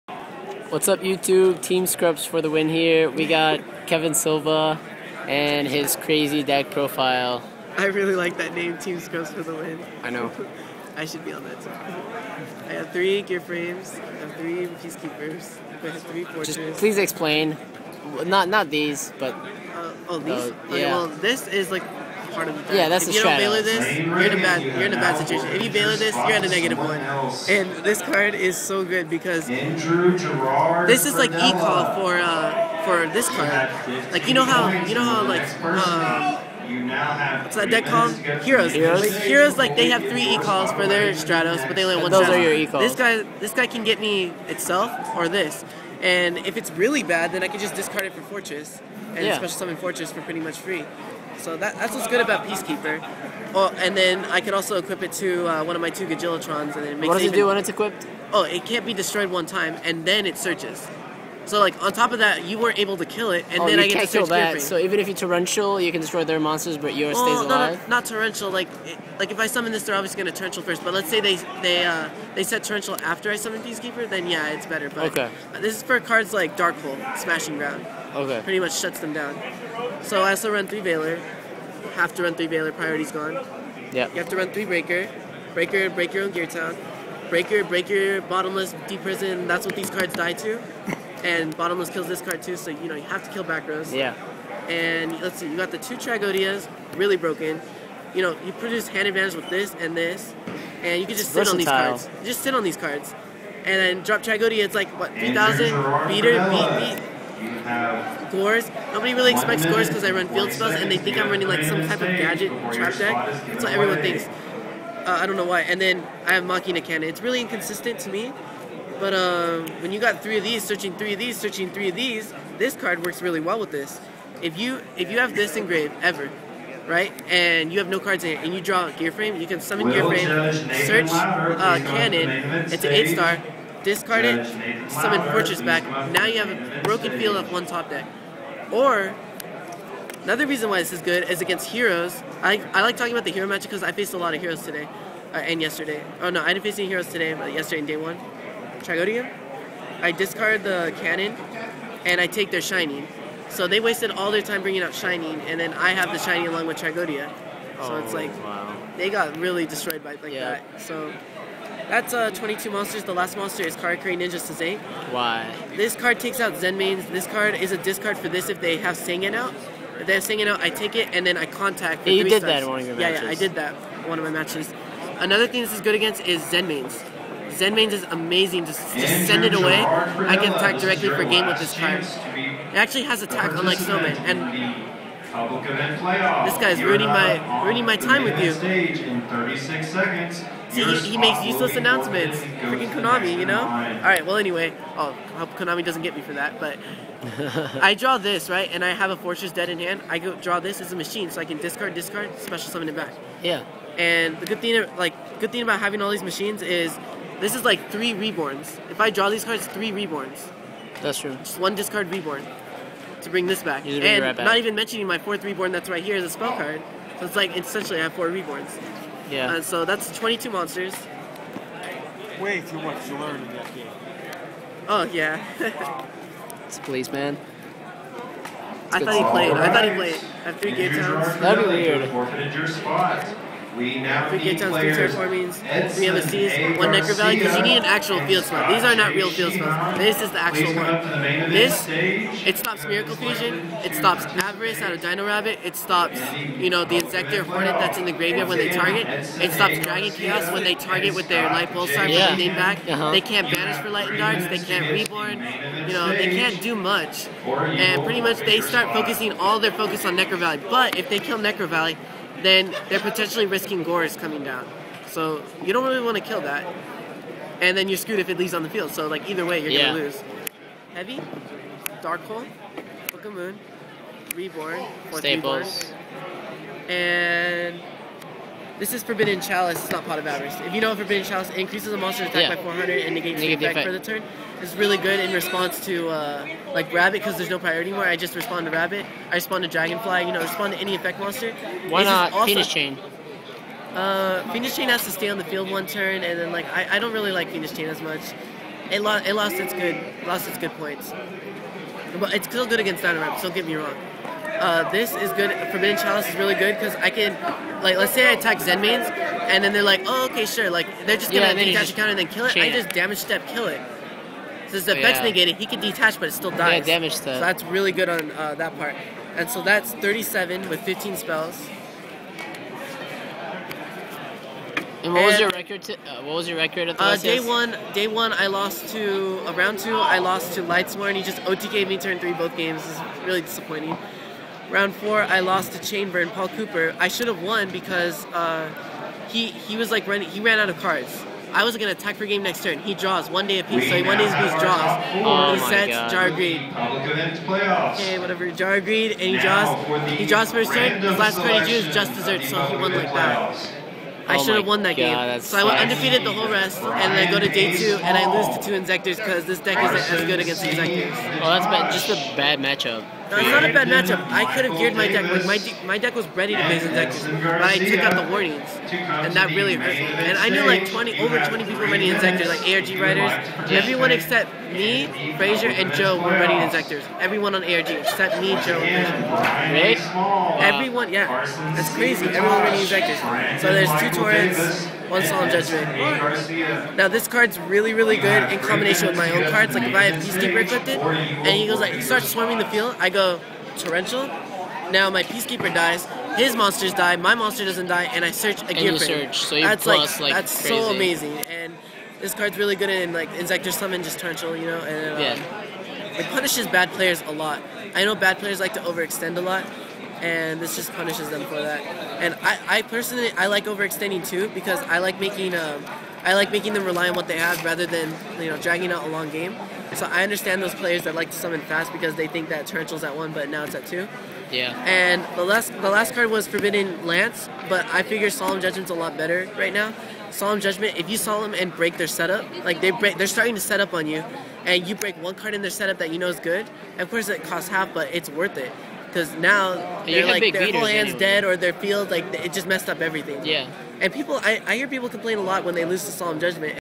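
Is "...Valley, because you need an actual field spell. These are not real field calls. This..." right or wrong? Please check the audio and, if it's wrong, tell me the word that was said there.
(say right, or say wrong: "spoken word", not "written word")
wrong: "spells", not "calls".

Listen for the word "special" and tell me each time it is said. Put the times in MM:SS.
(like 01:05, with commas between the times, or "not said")
00:49, 03:22.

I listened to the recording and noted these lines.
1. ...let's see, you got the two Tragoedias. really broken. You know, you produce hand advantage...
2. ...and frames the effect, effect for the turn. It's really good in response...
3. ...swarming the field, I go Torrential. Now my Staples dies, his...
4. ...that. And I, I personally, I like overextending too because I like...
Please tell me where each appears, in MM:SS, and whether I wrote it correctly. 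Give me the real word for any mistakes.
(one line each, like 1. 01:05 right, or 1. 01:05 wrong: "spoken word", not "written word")
1. 01:35 right
2. 04:43 wrong: "negates", not "frames"
3. 06:32 wrong: "Peacekeeper", not "Staples"
4. 06:51 right.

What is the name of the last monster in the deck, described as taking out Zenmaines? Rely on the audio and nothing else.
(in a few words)
Karakuri Ninja Sazane.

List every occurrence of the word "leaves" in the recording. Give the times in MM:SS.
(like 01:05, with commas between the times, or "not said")
04:28.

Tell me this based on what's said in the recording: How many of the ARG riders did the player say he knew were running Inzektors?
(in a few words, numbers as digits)
over 20.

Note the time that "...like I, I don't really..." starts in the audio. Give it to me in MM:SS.
04:56.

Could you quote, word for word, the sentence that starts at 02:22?
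I, I like talking about the hero match because I faced a lot of heroes today uh, and yesterday.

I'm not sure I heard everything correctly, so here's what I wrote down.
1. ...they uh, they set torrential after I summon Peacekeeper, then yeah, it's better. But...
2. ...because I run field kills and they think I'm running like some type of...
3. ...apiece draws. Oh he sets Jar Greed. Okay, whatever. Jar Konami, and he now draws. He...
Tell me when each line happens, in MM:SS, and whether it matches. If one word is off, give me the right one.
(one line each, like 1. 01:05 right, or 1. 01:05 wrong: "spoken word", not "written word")
1. 01:11 right
2. 01:49 wrong: "spells", not "kills"
3. 05:44 wrong: "Greed", not "Konami".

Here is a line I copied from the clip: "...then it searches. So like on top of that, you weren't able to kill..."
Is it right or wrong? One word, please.
right.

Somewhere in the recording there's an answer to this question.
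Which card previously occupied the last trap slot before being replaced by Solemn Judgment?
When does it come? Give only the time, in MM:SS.
07:06.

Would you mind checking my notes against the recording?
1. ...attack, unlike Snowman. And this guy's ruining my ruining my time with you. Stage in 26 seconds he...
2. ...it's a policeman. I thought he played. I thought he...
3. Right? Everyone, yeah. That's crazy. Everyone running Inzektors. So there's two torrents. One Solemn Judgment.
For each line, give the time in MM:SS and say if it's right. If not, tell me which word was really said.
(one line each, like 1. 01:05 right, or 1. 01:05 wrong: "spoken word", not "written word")
1. 03:03 wrong: "36", not "26"
2. 03:46 right
3. 06:20 right.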